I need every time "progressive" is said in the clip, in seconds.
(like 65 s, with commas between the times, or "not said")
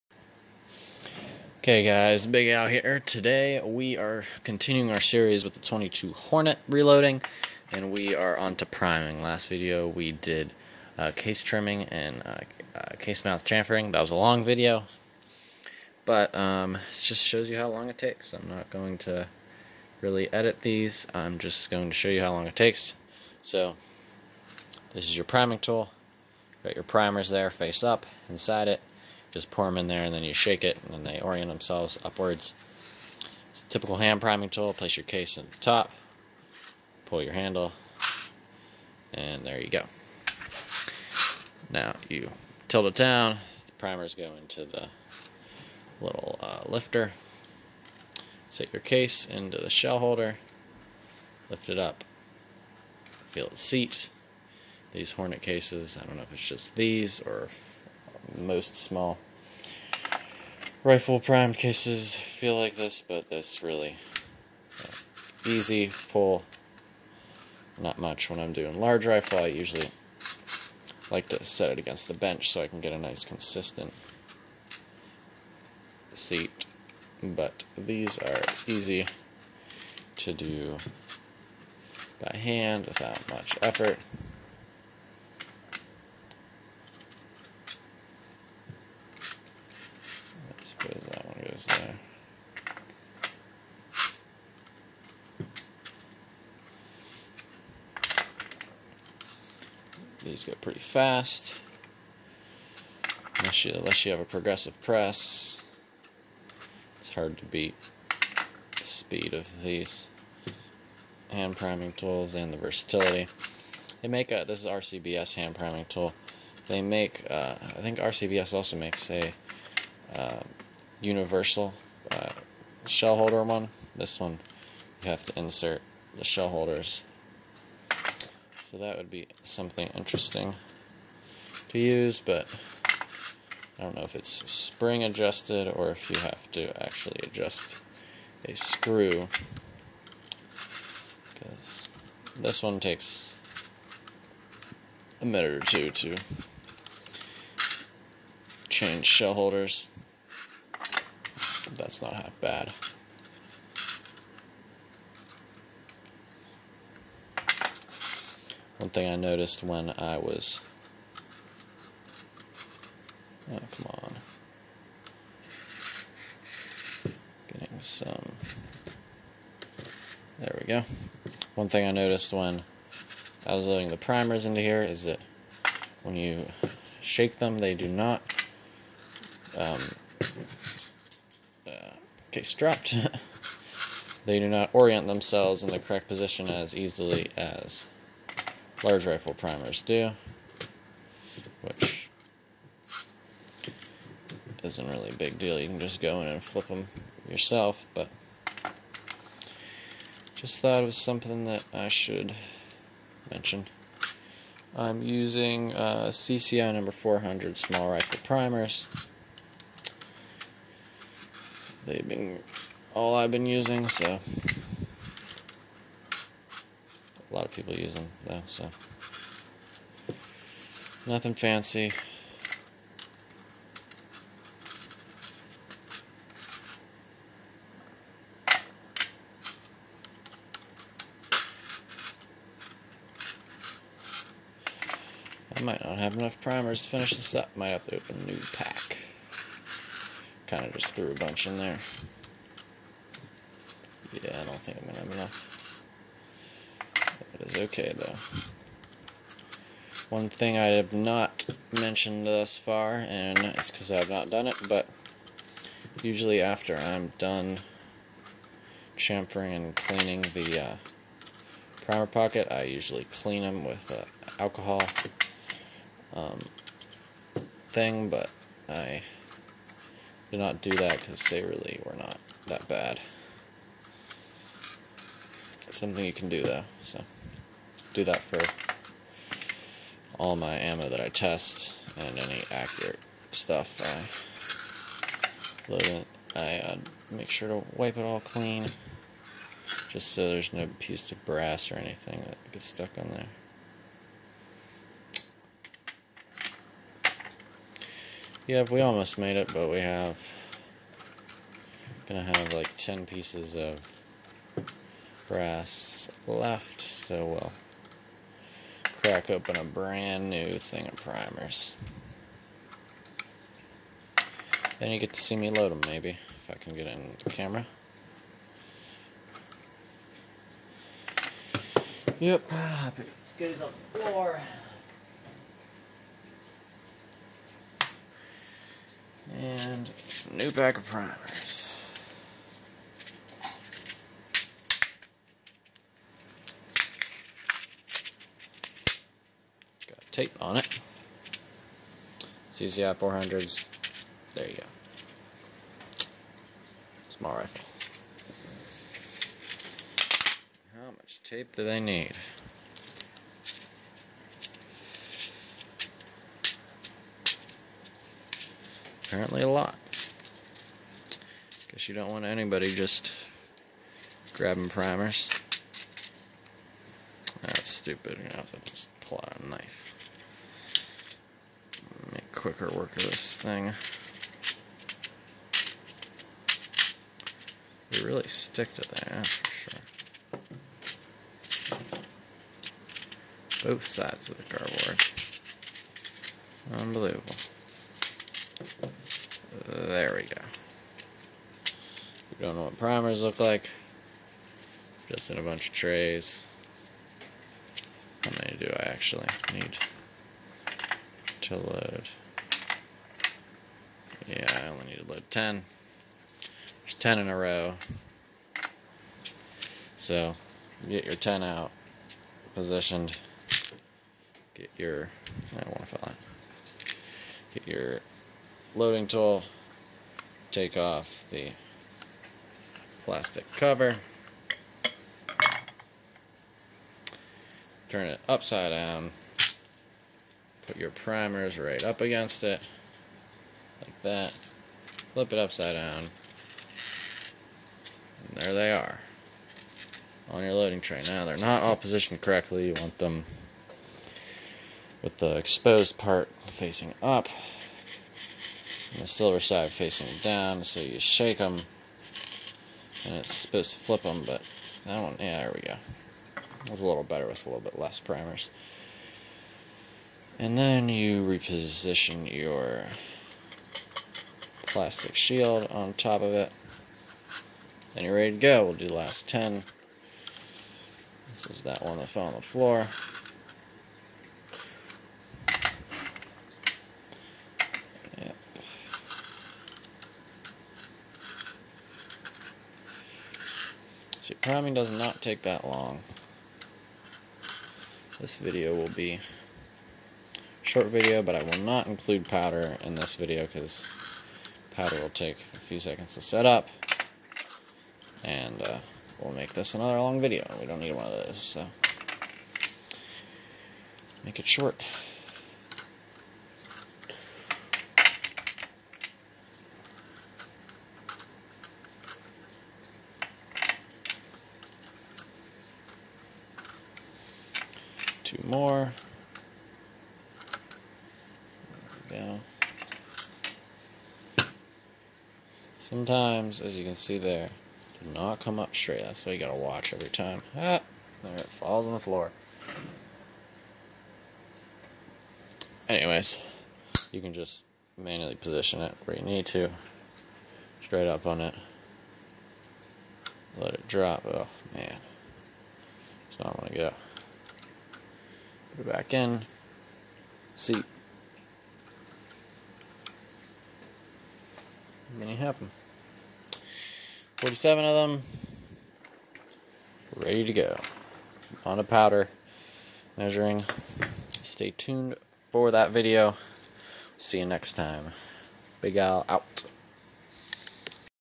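104 s.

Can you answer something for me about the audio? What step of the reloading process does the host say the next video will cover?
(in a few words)
powder measuring.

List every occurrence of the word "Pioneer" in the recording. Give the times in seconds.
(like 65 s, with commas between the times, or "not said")
not said.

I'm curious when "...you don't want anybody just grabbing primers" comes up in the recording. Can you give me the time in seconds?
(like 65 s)
361 s.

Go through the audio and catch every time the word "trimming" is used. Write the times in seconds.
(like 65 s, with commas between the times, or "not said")
11 s.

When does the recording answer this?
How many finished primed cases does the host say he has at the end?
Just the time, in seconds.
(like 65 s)
557 s.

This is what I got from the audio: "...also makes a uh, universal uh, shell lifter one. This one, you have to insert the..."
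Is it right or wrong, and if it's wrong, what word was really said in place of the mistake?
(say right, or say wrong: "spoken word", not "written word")
wrong: "holder", not "lifter".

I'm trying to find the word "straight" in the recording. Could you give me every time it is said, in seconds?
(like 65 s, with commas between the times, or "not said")
528 s, 540 s.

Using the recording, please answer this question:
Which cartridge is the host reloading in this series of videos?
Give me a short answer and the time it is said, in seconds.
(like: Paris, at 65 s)
22 Hornet, at 5 s.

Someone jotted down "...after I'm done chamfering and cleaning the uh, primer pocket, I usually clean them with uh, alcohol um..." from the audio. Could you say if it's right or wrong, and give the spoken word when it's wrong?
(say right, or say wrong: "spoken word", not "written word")
right.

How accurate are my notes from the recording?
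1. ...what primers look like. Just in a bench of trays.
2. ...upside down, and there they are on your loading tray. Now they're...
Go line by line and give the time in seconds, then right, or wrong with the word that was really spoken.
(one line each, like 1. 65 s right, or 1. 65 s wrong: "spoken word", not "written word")
1. 392 s wrong: "bunch", not "bench"
2. 435 s right.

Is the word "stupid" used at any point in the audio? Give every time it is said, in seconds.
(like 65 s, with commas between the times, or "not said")
367 s.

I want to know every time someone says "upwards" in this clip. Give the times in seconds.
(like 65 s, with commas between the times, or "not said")
32 s.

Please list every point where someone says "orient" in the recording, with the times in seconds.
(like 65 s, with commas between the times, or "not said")
31 s, 184 s.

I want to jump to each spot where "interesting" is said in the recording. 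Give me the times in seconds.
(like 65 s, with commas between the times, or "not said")
129 s.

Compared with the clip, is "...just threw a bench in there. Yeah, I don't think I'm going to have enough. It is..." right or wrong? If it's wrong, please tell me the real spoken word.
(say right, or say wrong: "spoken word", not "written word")
wrong: "bunch", not "bench".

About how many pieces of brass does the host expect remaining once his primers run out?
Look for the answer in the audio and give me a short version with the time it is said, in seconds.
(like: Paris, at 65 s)
10, at 302 s.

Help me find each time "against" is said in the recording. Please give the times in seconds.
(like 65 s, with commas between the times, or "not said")
71 s, 432 s.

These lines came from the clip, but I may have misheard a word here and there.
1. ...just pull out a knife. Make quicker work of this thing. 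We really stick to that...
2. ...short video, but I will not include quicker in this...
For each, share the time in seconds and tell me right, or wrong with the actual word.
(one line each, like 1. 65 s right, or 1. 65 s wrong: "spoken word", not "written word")
1. 368 s right
2. 490 s wrong: "powder", not "quicker".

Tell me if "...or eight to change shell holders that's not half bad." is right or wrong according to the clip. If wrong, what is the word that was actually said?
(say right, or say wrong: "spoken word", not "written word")
wrong: "two", not "eight".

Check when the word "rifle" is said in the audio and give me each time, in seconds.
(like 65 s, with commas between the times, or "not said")
60 s, 69 s, 189 s, 207 s, 347 s.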